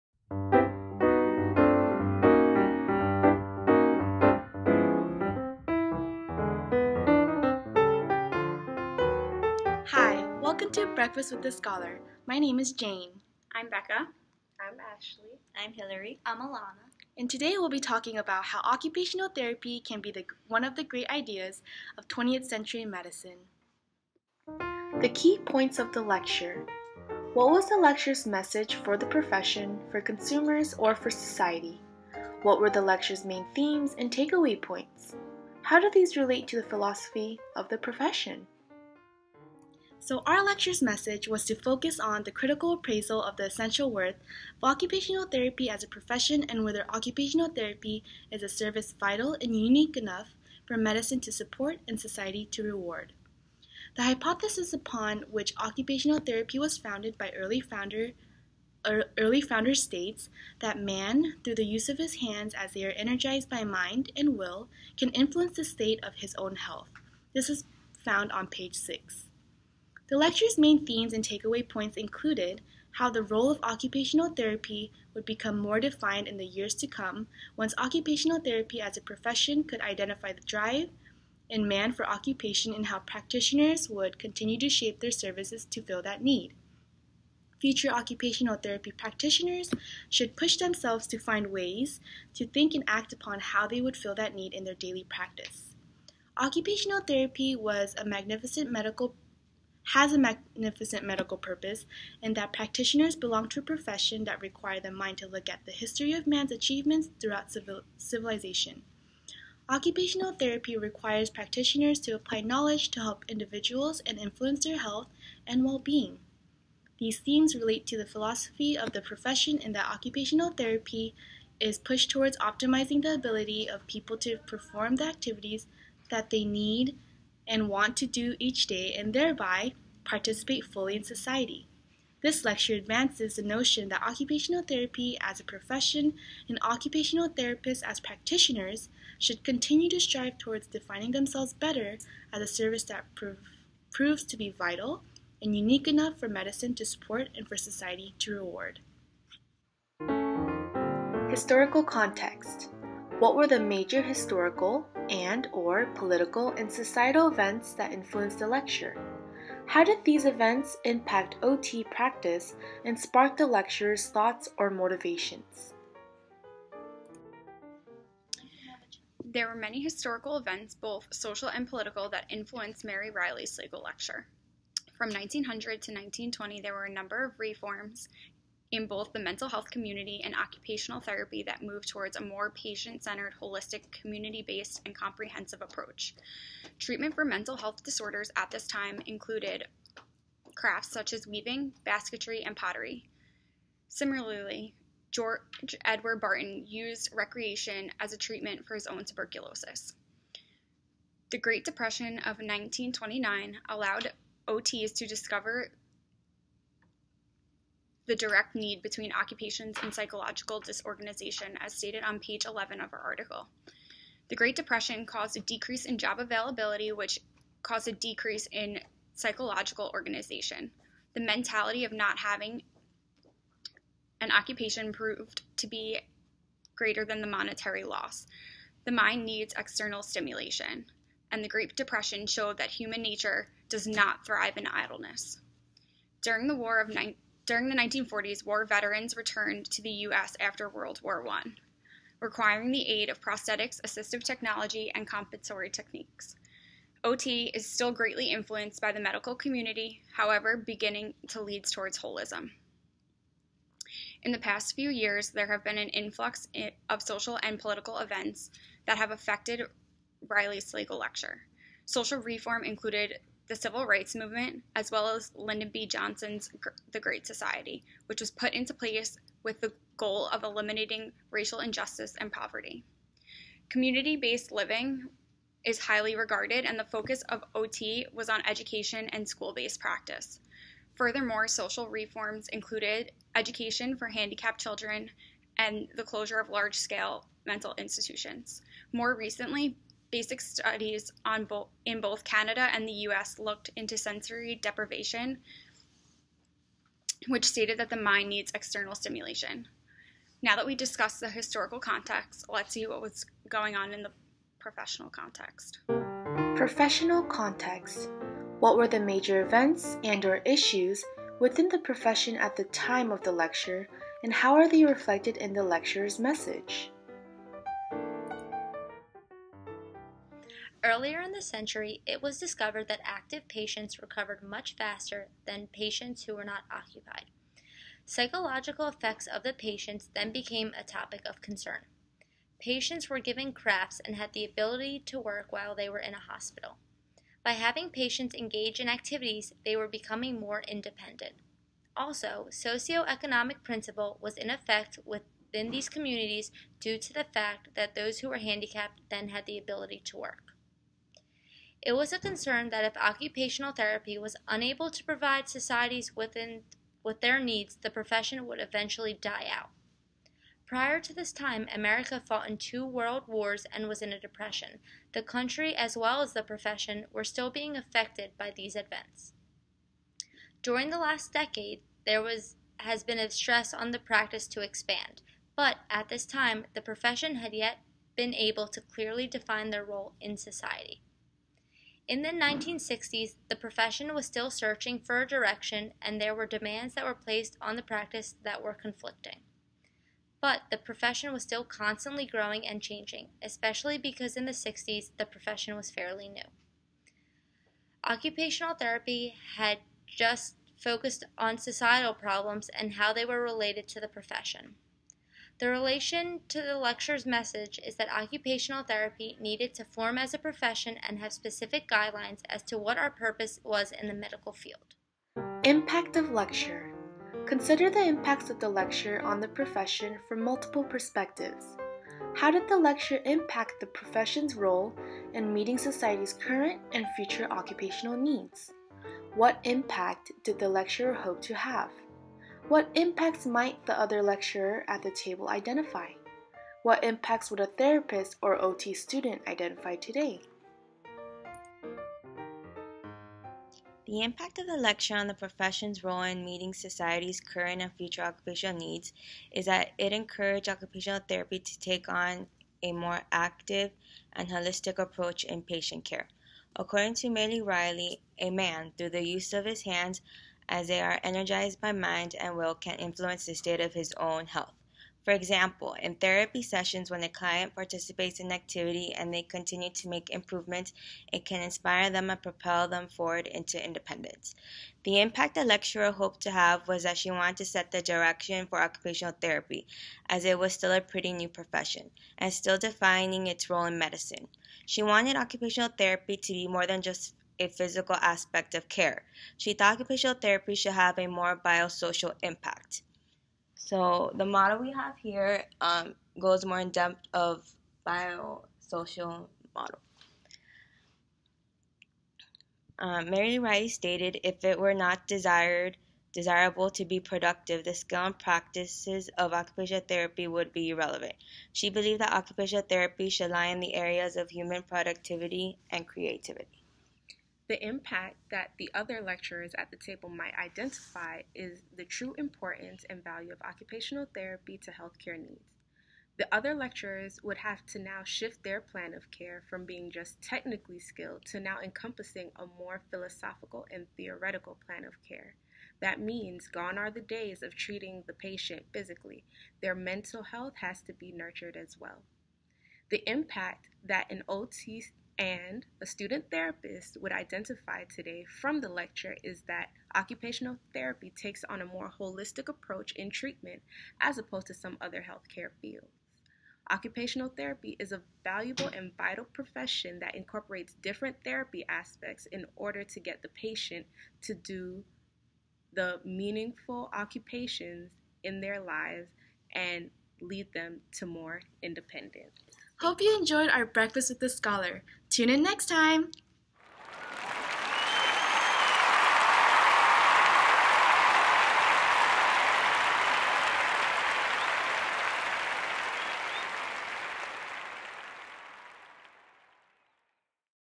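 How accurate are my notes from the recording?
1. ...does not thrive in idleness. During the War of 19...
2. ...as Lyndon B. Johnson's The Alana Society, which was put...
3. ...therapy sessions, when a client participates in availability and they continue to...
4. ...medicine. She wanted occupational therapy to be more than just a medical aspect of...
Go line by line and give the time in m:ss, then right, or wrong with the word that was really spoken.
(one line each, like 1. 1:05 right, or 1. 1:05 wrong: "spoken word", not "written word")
1. 3:53 right
2. 4:25 wrong: "Great", not "Alana"
3. 7:46 wrong: "activity", not "availability"
4. 8:03 wrong: "physical", not "medical".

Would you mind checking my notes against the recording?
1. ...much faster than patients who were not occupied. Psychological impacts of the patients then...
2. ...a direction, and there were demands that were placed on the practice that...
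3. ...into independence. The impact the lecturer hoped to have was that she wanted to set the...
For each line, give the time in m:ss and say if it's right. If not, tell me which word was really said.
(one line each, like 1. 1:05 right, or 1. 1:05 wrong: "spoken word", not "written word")
1. 5:24 wrong: "effects", not "impacts"
2. 6:25 right
3. 7:53 right.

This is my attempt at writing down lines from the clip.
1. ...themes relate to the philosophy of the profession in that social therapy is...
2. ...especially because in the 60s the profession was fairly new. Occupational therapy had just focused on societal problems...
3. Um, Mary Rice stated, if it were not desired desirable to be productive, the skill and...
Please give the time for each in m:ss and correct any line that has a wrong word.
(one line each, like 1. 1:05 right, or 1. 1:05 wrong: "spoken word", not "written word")
1. 1:57 wrong: "occupational", not "social"
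2. 6:33 right
3. 8:22 right.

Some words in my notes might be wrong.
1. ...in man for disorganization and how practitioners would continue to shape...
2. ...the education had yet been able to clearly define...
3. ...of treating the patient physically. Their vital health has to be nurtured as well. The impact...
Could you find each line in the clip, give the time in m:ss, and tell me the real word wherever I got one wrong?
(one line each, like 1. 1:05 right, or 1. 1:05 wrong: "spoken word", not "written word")
1. 1:21 wrong: "occupation", not "disorganization"
2. 6:16 wrong: "profession", not "education"
3. 8:57 wrong: "mental", not "vital".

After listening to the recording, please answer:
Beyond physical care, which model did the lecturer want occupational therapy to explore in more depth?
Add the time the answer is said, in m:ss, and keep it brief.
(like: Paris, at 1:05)
Biosocial model, at 8:18.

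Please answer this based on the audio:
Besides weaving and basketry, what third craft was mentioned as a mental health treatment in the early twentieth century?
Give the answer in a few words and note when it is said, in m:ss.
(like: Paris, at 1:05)
Pottery, at 3:12.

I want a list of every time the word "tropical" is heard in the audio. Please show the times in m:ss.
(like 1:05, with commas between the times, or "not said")
not said.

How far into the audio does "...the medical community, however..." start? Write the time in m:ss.
4:08.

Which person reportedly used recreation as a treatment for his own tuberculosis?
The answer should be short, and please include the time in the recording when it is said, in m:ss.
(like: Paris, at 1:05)
George Edward Barton, at 3:15.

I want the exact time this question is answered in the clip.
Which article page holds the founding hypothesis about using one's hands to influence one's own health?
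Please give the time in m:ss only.
1:08.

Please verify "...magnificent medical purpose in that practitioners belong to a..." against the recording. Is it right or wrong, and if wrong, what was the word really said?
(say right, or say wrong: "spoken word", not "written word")
right.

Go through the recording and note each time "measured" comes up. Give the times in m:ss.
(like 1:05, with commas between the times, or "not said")
not said.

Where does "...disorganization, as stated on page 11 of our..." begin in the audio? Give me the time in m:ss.
3:30.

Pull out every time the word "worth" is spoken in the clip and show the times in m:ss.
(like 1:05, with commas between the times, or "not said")
0:43.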